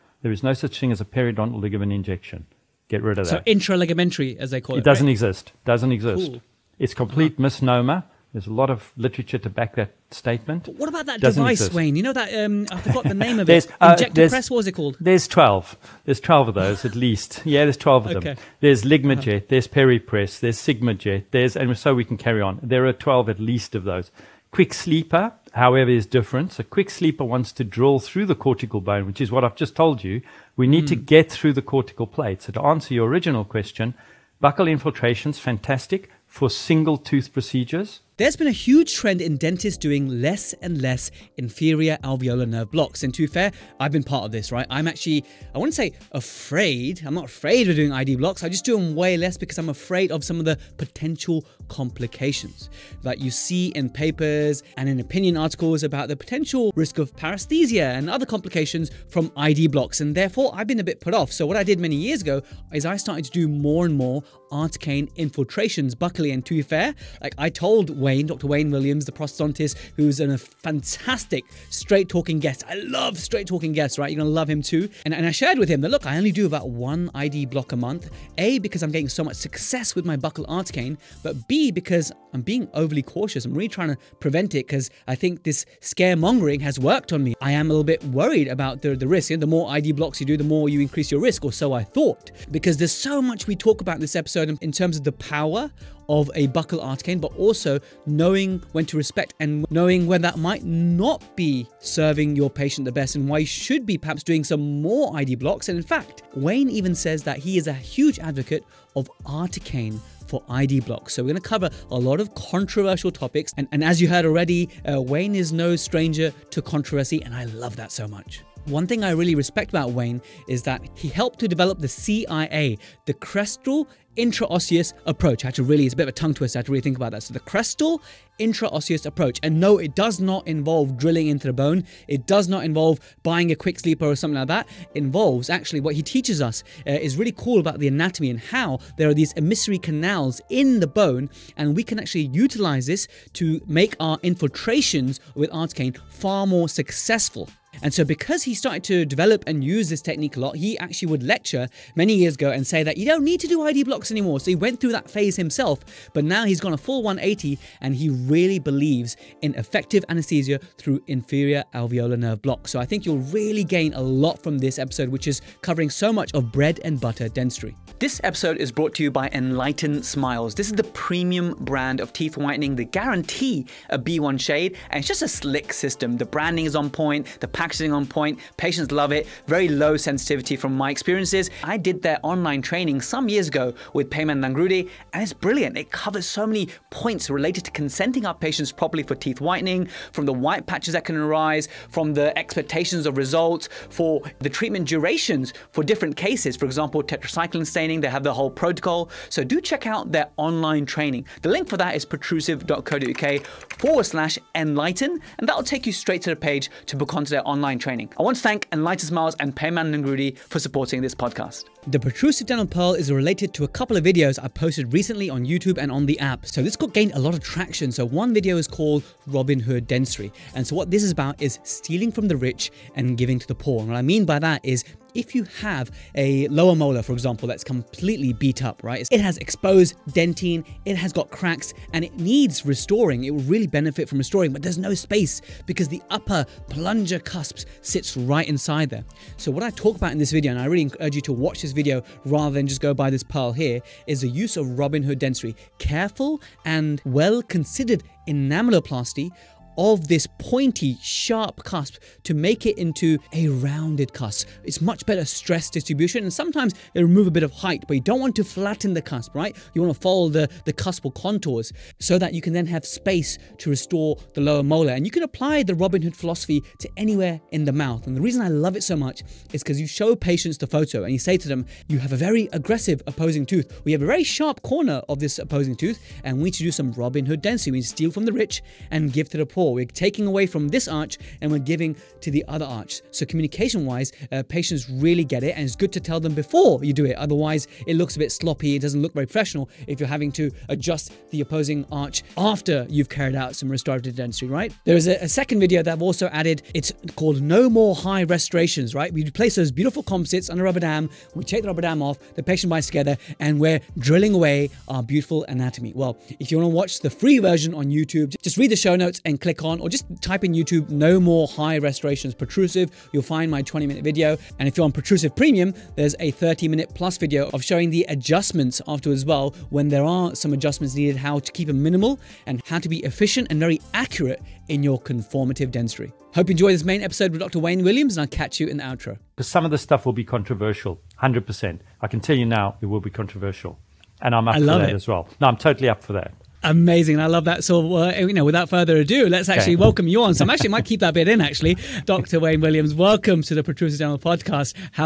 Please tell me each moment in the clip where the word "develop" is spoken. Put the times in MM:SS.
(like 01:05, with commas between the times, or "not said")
02:01, 02:29.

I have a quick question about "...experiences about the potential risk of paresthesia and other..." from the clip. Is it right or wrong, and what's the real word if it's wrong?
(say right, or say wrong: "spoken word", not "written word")
wrong: "articles", not "experiences".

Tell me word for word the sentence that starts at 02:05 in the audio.
I had to really, it's a bit of a tongue twister, I to really think about that.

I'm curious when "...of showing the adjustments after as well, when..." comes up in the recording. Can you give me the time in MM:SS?
05:17.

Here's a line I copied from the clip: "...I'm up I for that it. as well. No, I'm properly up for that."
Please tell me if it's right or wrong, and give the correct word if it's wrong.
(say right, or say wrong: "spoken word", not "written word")
wrong: "totally", not "properly".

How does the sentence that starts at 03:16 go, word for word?
For example, tetracycline staining, they have the whole protocol.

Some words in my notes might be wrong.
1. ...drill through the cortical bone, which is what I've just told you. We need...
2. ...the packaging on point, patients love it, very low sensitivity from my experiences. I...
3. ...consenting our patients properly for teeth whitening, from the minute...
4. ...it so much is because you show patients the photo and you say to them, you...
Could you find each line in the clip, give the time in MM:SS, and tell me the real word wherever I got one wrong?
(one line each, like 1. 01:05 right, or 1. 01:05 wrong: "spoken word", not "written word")
1. 00:27 right
2. 02:57 right
3. 03:07 wrong: "white", not "minute"
4. 04:28 right.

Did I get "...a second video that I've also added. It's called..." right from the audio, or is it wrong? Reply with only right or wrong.
right.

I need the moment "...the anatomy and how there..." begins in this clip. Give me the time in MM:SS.
02:17.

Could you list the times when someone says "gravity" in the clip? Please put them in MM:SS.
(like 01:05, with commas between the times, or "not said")
not said.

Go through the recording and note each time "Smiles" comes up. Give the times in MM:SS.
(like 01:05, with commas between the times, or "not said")
02:50, 03:29.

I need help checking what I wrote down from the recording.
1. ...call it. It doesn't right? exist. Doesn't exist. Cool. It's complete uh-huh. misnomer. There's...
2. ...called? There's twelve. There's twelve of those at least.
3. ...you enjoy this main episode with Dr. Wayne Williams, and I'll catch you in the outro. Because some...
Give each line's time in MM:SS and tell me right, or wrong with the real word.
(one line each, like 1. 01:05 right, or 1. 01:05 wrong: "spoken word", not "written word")
1. 00:04 right
2. 00:14 right
3. 05:26 right.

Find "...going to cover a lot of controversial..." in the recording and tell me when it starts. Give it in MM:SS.
01:51.